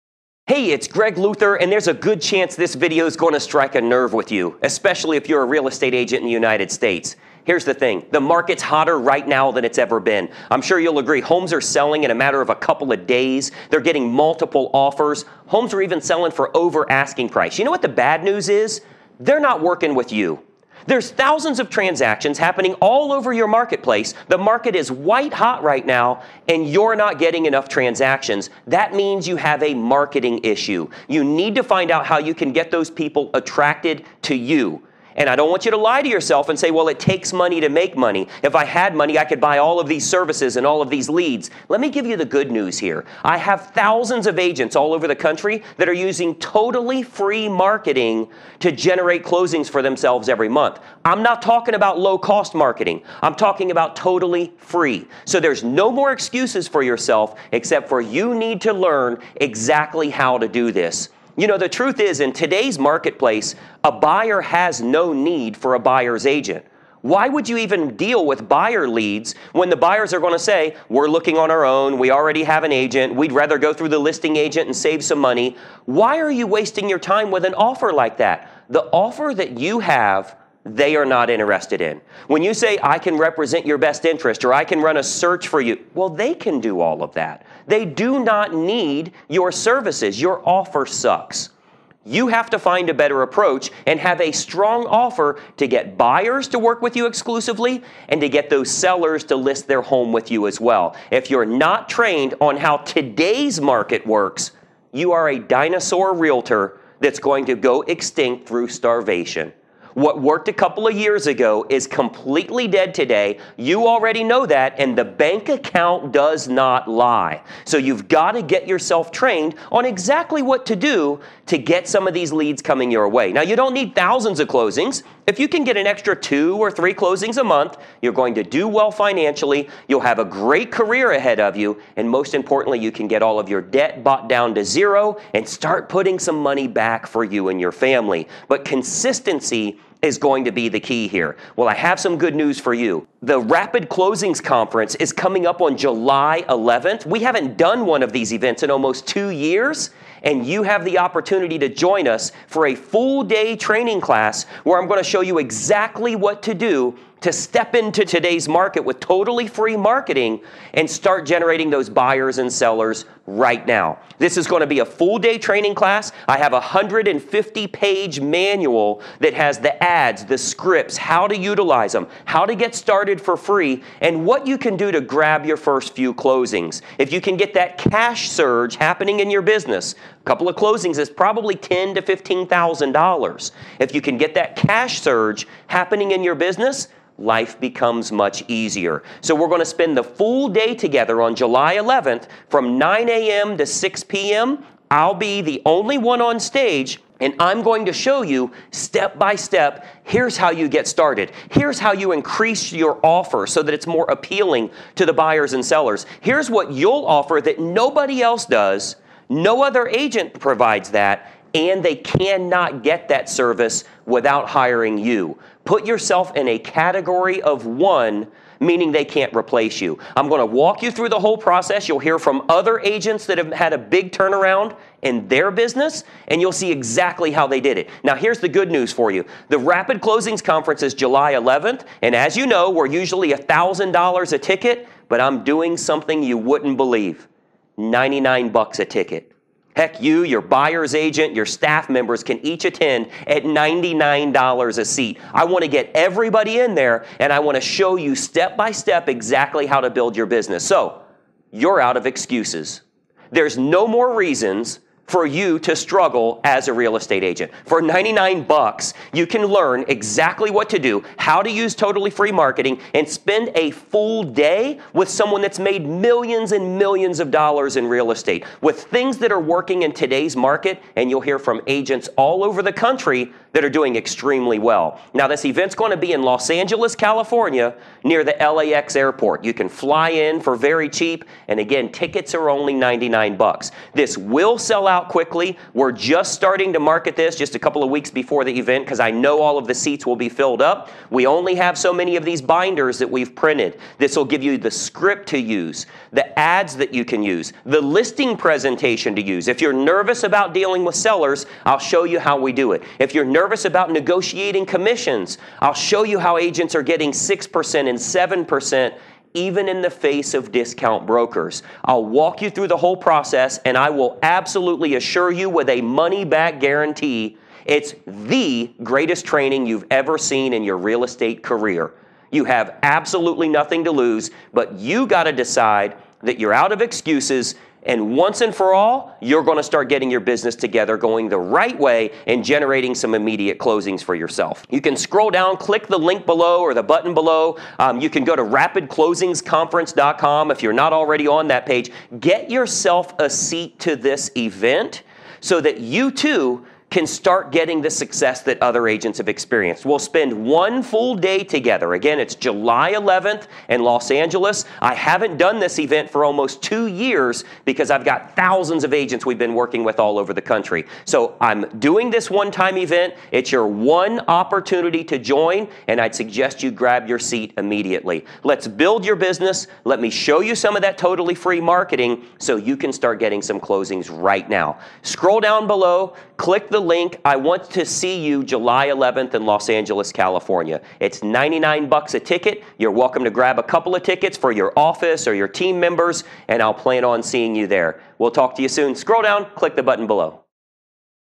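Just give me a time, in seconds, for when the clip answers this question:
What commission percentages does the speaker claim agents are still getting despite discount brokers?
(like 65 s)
307 s.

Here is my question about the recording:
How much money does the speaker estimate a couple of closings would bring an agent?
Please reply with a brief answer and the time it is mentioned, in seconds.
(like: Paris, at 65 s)
$10,000 to $15,000, at 181 s.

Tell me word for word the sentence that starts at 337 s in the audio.
Um, you can go to rapidclosingsconference.com if you're not already on that page.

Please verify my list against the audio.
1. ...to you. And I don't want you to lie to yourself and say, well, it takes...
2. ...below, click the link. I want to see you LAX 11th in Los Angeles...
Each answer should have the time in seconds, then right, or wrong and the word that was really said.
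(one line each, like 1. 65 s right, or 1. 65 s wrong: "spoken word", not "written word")
1. 34 s right
2. 375 s wrong: "July", not "LAX".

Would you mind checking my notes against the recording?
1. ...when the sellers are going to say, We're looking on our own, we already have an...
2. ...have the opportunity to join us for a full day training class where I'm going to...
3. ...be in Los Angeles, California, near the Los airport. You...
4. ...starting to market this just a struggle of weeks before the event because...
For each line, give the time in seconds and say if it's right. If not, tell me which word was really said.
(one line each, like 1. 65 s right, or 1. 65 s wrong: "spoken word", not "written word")
1. 69 s wrong: "buyers", not "sellers"
2. 150 s right
3. 275 s wrong: "LAX", not "Los"
4. 286 s wrong: "couple", not "struggle".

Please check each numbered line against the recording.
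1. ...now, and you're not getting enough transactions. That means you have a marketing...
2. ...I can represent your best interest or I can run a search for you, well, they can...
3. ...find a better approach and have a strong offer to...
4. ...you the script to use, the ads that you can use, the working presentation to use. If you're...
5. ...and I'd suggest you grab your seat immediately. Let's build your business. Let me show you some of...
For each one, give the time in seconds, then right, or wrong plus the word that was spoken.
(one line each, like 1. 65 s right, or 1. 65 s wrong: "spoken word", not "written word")
1. 25 s right
2. 82 s right
3. 92 s right
4. 294 s wrong: "listing", not "working"
5. 365 s right.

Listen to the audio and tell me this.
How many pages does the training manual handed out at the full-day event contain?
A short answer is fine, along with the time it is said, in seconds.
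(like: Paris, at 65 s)
150, at 166 s.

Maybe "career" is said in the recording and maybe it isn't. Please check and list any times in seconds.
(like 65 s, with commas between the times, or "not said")
130 s, 321 s.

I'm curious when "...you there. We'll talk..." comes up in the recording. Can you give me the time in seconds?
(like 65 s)
387 s.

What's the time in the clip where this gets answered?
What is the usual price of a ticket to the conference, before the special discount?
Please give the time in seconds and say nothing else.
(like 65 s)
233 s.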